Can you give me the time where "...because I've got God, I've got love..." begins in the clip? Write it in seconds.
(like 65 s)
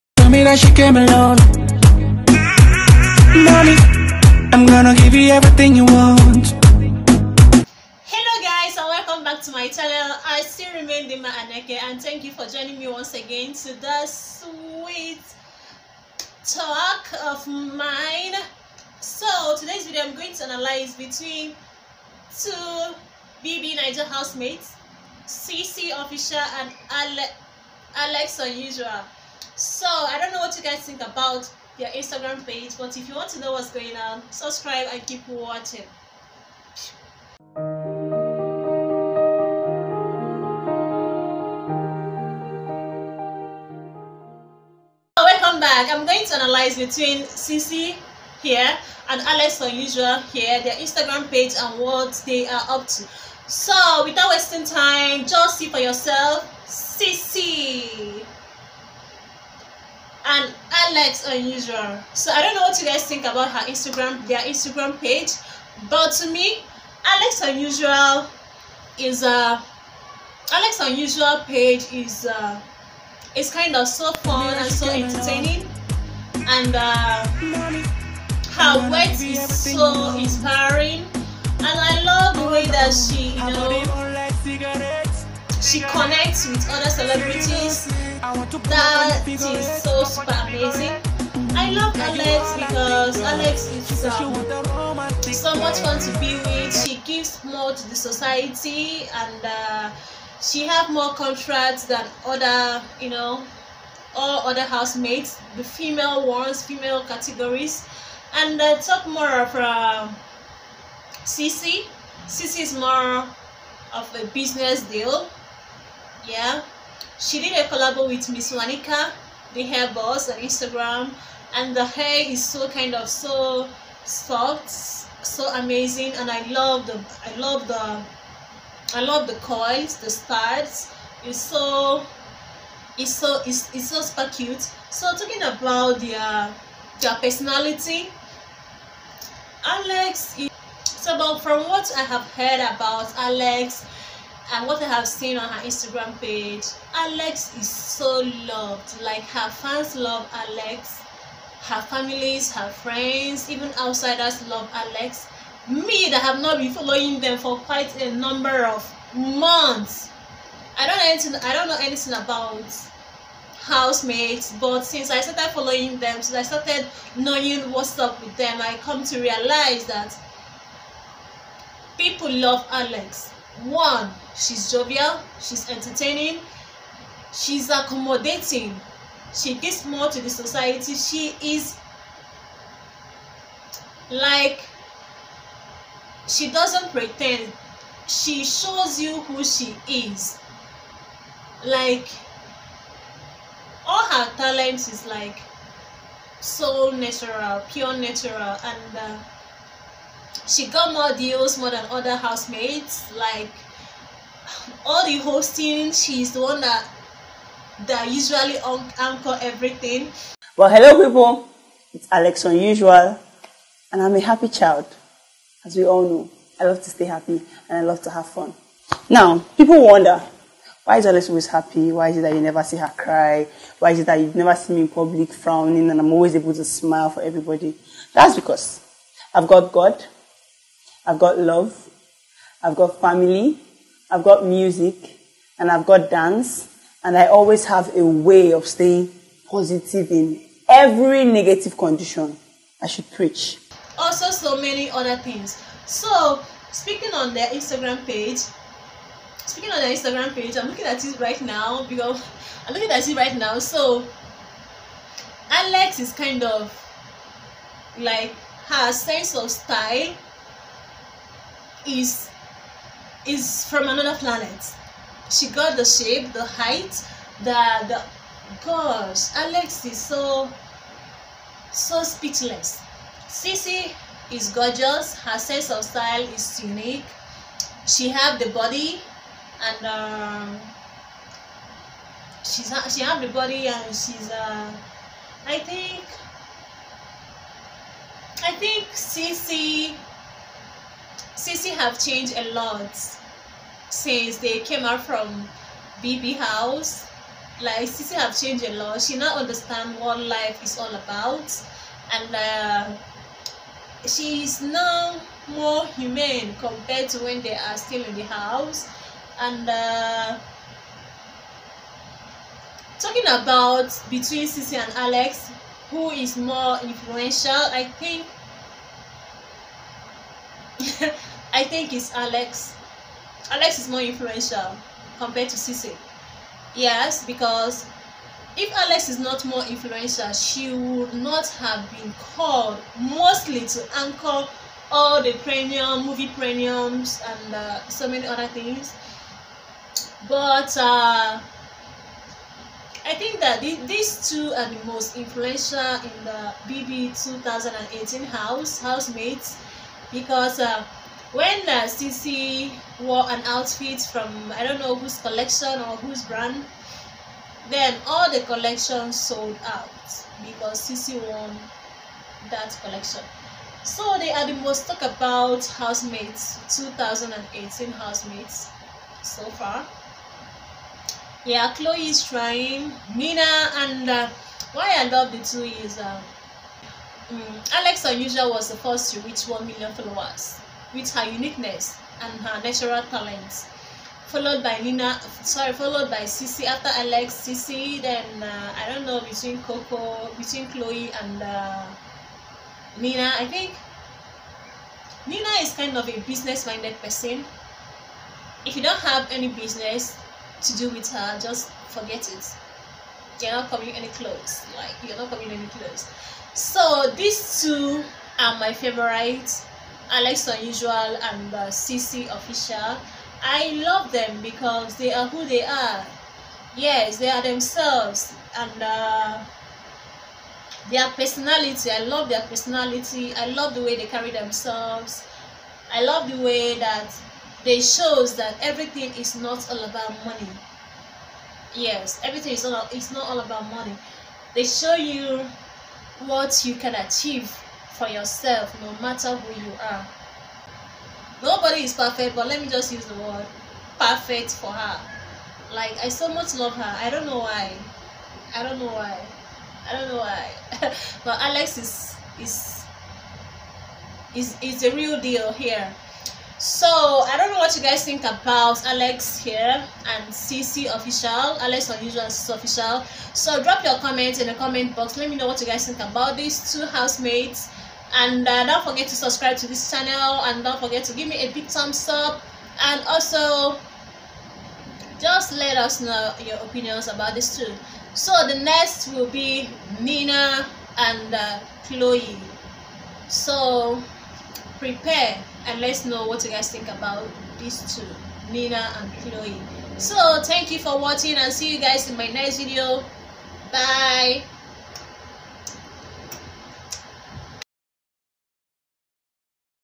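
228 s.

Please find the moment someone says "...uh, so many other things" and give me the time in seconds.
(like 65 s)
337 s.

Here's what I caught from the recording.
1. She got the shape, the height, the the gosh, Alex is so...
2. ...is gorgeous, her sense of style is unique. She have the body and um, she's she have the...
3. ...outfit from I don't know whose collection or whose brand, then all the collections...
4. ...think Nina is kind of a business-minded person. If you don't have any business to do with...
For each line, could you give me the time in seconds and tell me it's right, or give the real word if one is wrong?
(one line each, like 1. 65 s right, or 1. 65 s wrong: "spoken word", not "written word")
1. 265 s right
2. 274 s right
3. 353 s right
4. 393 s right.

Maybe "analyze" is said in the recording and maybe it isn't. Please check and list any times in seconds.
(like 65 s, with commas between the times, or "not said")
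20 s, 46 s.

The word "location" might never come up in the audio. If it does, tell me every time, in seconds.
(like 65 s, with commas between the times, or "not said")
not said.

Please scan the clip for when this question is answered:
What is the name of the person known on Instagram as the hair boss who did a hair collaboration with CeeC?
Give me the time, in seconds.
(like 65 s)
118 s.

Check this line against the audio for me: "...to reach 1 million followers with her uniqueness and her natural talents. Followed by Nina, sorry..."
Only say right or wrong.
right.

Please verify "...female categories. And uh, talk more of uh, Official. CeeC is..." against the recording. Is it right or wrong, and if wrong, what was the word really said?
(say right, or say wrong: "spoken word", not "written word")
wrong: "CeeC", not "Official".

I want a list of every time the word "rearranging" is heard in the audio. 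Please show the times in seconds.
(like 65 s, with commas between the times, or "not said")
not said.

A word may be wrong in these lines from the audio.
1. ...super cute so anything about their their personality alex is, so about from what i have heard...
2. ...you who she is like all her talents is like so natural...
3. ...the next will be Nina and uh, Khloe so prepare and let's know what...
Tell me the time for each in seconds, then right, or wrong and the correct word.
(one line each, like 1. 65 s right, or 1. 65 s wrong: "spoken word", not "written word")
1. 134 s wrong: "talking", not "anything"
2. 188 s right
3. 478 s right.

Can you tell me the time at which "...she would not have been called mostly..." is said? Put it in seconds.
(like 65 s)
330 s.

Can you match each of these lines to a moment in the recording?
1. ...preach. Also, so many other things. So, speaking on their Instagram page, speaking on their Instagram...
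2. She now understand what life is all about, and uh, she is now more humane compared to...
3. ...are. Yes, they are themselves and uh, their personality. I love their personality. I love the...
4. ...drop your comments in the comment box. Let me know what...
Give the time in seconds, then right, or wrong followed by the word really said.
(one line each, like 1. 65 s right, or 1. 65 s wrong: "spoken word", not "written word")
1. 243 s right
2. 299 s right
3. 415 s right
4. 463 s right.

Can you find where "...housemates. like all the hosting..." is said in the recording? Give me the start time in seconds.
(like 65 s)
202 s.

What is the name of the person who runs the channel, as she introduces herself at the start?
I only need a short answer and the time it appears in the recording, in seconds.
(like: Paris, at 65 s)
Dima Aneke, at 11 s.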